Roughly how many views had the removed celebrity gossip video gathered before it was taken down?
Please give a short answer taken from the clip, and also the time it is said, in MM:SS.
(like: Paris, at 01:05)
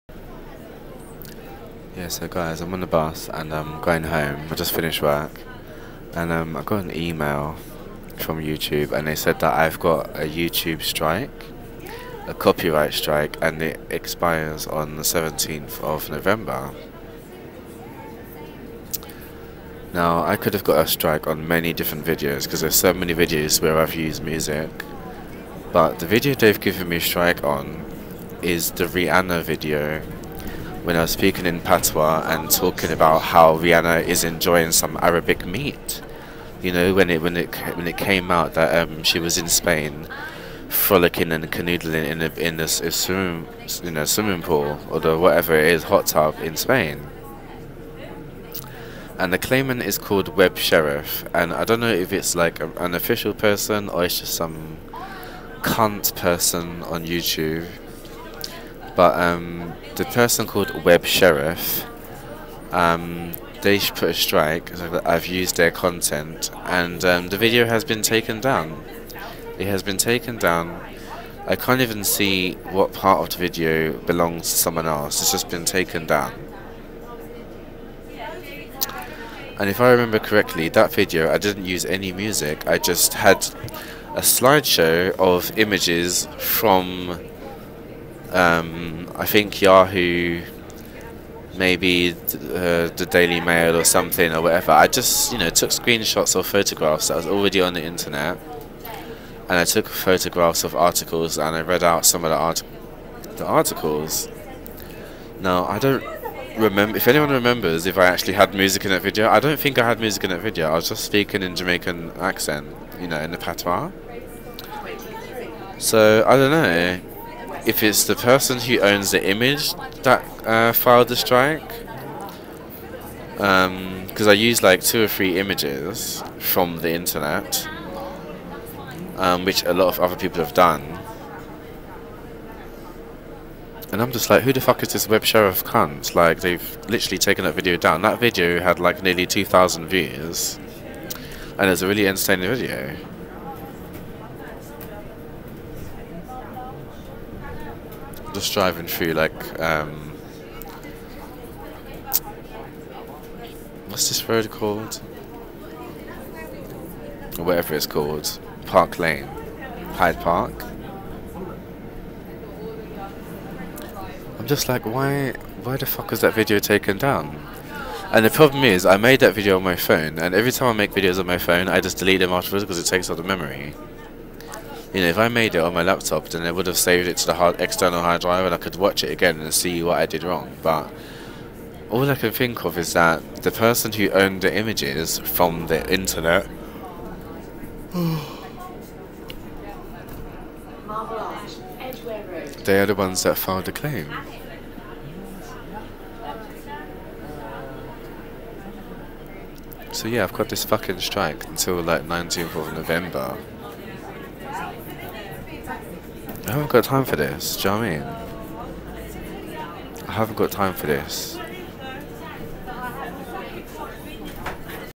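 2,000, at 02:19.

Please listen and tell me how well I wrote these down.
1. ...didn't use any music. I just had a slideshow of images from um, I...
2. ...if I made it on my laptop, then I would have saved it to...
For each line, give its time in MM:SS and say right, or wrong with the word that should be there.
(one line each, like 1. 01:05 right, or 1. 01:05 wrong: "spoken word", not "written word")
1. 01:21 right
2. 02:55 right.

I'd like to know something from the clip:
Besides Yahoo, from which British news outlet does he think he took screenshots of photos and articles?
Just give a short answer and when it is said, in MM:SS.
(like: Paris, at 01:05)
the Daily Mail, at 01:32.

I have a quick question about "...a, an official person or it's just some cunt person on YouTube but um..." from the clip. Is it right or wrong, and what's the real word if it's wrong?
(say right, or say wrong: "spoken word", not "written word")
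right.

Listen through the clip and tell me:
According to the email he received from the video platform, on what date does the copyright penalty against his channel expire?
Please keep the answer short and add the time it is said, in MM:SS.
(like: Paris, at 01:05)
17th of November, at 00:15.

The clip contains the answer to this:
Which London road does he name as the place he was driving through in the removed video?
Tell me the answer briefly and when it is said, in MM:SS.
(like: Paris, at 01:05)
Park Lane, at 02:38.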